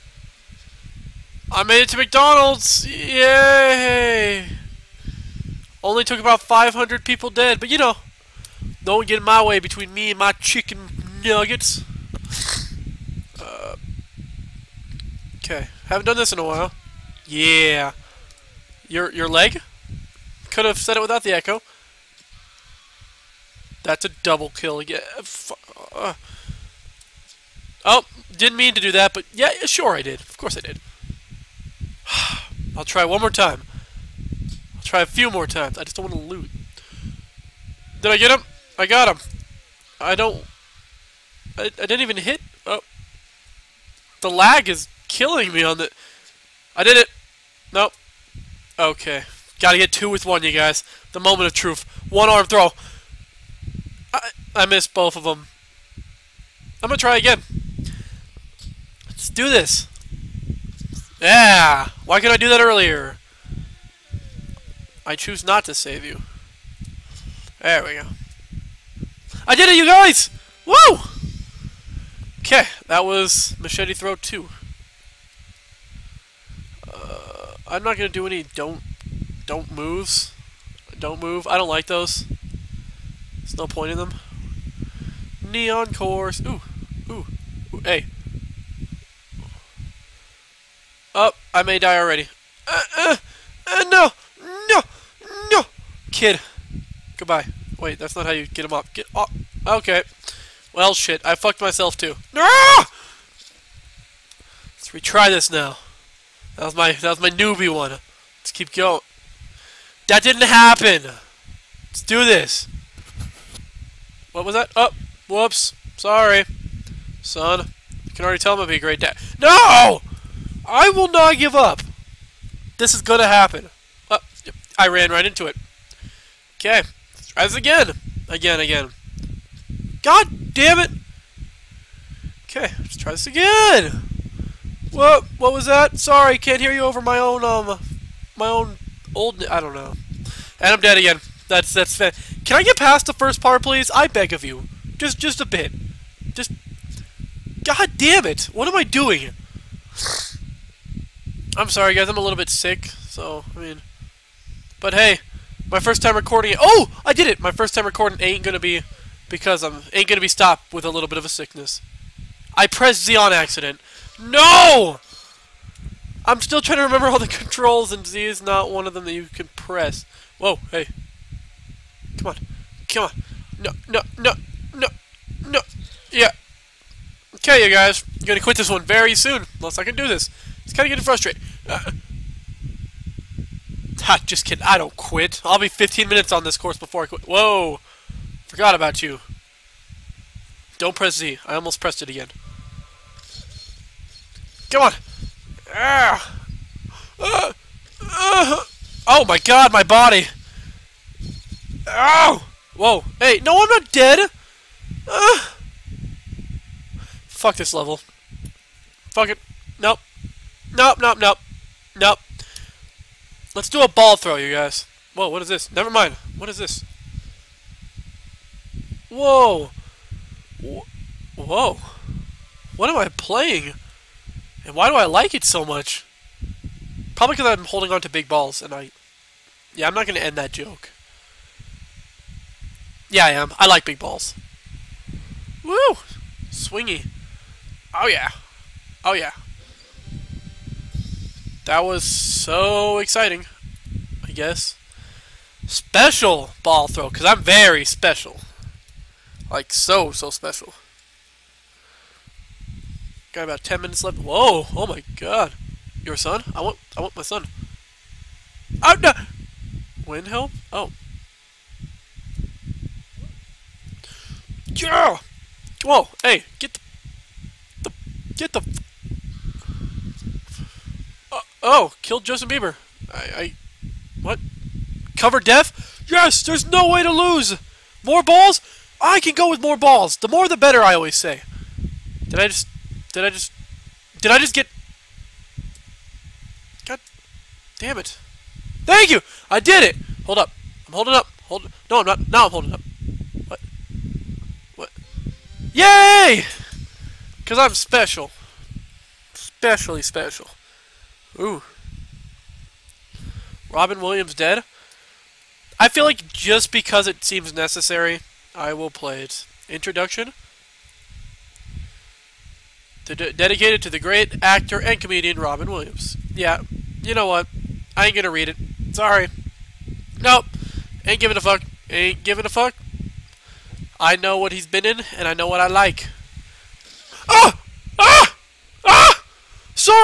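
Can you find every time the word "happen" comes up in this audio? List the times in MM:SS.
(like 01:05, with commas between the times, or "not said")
01:50, 02:03.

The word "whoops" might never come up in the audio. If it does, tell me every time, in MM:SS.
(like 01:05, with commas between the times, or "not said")
01:55.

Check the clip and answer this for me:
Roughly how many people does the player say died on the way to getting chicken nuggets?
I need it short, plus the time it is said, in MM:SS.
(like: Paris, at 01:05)
500, at 00:06.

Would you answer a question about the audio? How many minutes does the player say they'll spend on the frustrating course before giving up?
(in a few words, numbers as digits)
15.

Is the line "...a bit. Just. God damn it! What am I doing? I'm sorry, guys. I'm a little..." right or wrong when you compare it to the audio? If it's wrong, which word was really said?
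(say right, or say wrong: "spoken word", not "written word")
right.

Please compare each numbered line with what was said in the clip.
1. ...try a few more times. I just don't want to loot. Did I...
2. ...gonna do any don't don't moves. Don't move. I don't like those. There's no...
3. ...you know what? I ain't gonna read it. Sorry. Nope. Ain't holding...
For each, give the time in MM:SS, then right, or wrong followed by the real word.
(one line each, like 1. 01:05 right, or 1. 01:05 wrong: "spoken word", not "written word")
1. 00:34 right
2. 01:17 right
3. 05:17 wrong: "giving", not "holding".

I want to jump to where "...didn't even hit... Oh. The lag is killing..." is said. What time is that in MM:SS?
00:41.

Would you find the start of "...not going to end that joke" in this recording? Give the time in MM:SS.
03:49.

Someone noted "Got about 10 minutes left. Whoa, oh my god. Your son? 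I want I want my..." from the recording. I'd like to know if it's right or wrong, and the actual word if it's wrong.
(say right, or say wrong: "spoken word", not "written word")
right.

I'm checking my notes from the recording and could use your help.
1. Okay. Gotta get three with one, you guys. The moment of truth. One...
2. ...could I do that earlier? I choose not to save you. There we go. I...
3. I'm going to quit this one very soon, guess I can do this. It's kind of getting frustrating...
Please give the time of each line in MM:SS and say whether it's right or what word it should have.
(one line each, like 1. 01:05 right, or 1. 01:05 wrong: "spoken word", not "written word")
1. 00:48 wrong: "two", not "three"
2. 01:02 right
3. 02:58 wrong: "unless", not "guess".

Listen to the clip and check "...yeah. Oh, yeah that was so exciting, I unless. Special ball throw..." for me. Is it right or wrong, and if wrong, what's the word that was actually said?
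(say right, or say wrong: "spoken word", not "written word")
wrong: "guess", not "unless".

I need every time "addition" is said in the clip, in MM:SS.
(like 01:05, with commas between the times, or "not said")
not said.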